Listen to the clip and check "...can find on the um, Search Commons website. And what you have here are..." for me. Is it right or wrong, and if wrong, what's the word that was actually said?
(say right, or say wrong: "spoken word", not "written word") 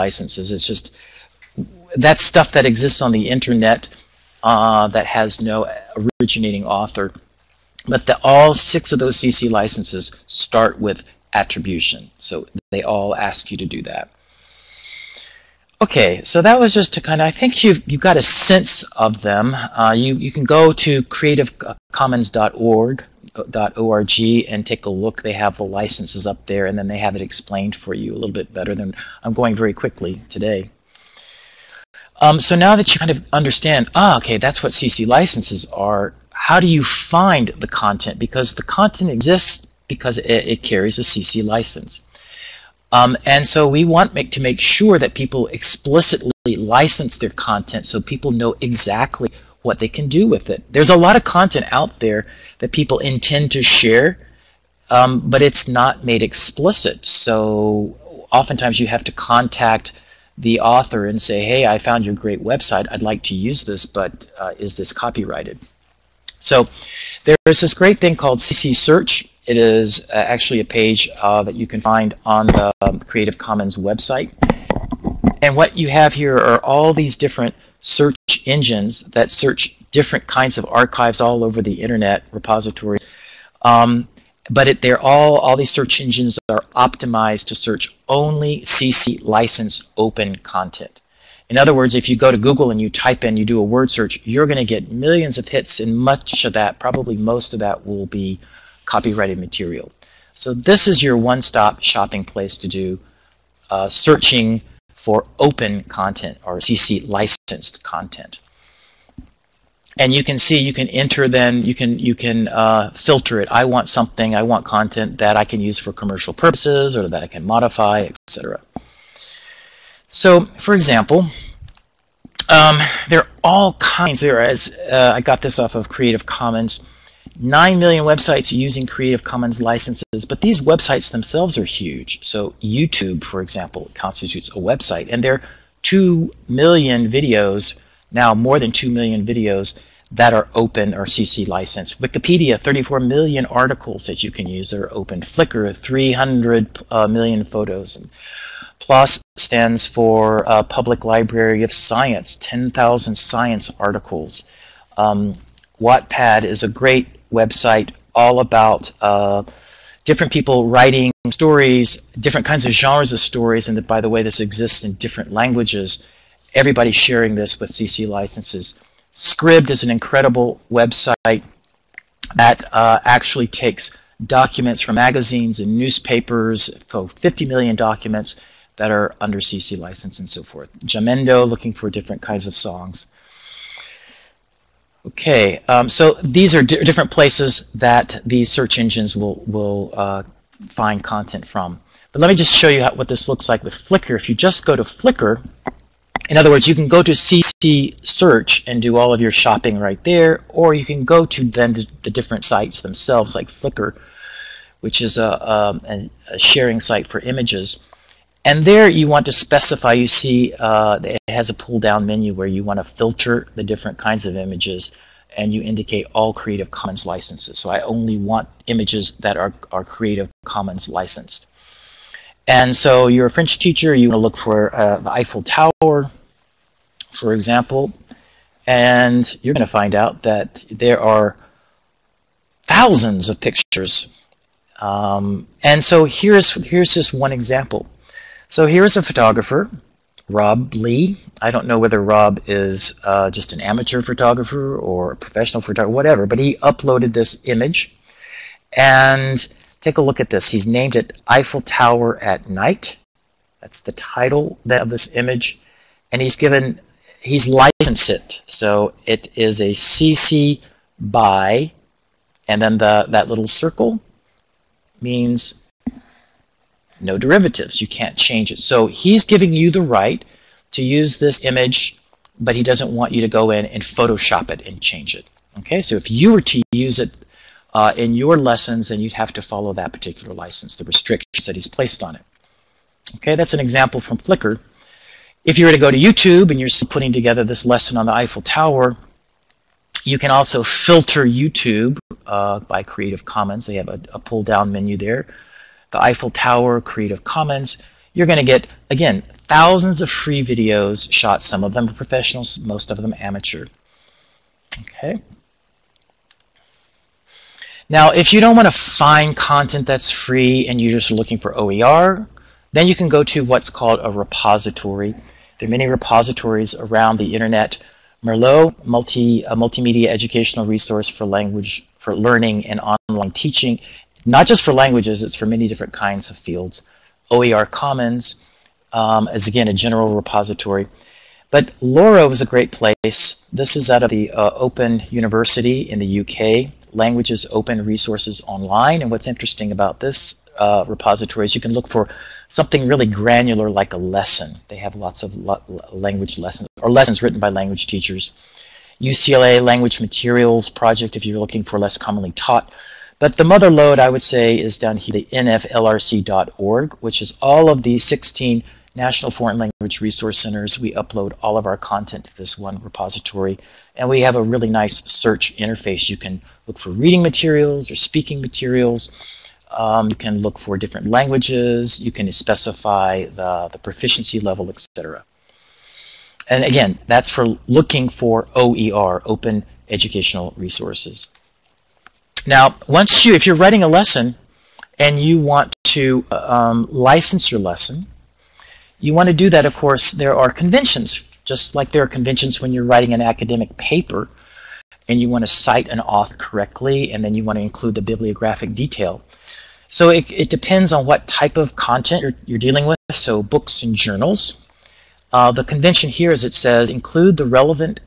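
wrong: "Creative", not "Search".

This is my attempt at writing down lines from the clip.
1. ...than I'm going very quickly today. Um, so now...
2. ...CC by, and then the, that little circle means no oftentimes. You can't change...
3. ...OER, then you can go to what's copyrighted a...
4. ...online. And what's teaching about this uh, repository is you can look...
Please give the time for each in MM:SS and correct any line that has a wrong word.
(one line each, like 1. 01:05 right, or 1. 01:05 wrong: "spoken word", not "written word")
1. 00:28 right
2. 04:19 wrong: "derivatives", not "oftentimes"
3. 05:11 wrong: "called", not "copyrighted"
4. 05:38 wrong: "interesting", not "teaching".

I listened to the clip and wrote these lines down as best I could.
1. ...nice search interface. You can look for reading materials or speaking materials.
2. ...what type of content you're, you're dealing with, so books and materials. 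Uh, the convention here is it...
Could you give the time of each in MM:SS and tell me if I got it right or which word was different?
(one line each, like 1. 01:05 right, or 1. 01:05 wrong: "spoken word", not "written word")
1. 06:04 right
2. 06:41 wrong: "journals", not "materials".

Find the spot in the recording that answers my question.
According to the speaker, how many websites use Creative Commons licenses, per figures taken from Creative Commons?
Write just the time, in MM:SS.
02:07.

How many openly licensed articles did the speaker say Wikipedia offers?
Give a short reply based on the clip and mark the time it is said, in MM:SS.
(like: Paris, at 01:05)
34 million, at 02:22.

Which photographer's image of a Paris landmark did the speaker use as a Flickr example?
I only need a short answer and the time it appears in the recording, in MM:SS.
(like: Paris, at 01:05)
Rob Lee, at 04:00.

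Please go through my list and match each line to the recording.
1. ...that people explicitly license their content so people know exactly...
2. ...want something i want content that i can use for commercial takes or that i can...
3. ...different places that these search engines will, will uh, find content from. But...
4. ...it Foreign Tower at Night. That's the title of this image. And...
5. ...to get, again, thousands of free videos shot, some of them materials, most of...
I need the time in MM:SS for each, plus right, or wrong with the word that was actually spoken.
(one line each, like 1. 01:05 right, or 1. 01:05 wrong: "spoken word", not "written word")
1. 00:44 right
2. 01:53 wrong: "purposes", not "takes"
3. 03:06 right
4. 04:10 wrong: "Eiffel", not "Foreign"
5. 04:58 wrong: "professionals", not "materials".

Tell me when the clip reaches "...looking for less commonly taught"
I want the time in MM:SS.
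05:51.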